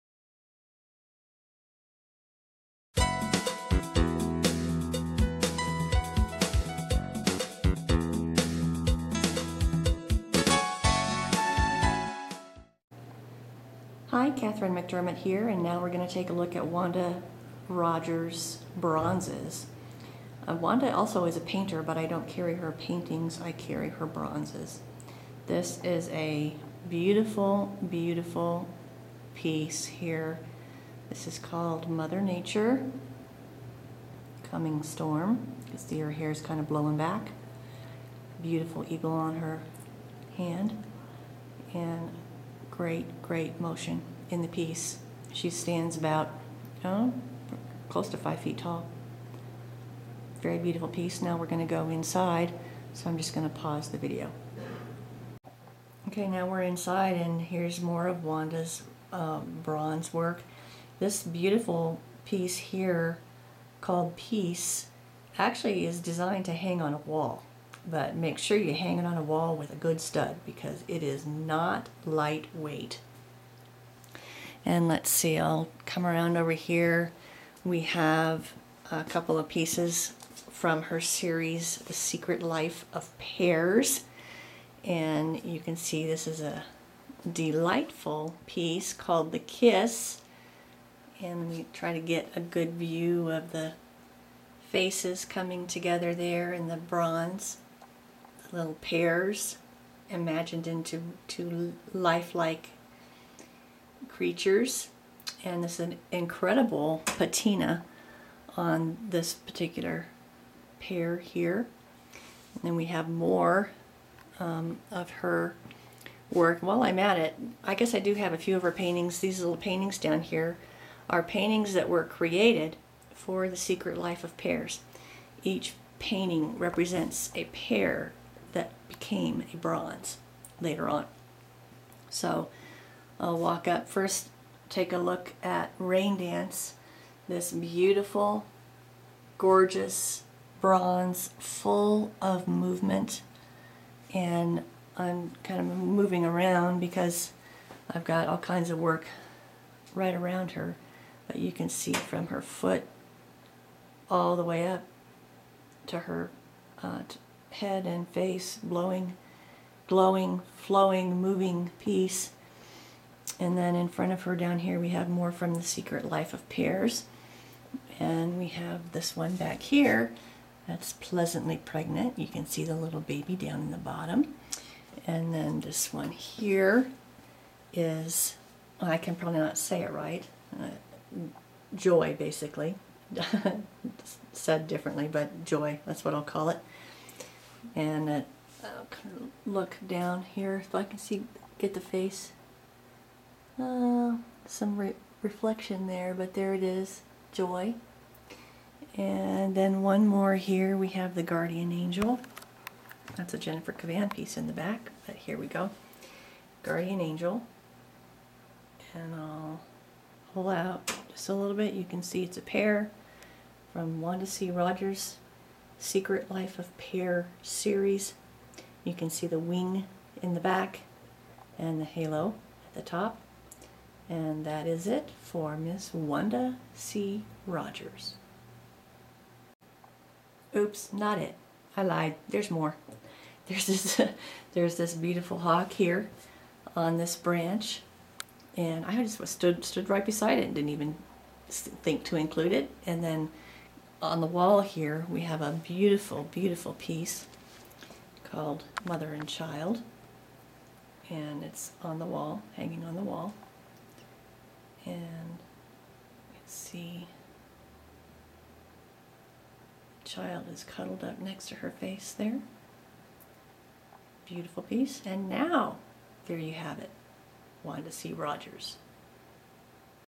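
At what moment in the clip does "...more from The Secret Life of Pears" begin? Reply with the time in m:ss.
2:45.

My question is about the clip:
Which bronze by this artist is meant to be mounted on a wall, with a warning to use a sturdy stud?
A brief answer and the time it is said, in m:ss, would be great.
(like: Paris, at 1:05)
Peace, at 1:04.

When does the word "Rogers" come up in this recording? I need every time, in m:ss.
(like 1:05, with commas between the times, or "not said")
0:17, 3:34, 3:47, 4:28.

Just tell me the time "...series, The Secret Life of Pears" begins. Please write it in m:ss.
1:21.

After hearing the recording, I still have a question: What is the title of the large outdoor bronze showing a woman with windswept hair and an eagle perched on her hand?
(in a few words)
Mother Nature Coming Storm.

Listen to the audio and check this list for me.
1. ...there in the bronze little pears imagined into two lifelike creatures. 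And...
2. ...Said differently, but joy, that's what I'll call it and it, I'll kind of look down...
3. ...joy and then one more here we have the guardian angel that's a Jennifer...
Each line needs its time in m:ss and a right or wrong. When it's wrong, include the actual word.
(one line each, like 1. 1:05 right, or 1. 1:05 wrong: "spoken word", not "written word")
1. 1:36 right
2. 3:04 right
3. 3:17 right.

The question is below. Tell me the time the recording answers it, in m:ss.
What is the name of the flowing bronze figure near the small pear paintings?
2:15.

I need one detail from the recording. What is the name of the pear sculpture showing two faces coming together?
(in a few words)
The Kiss.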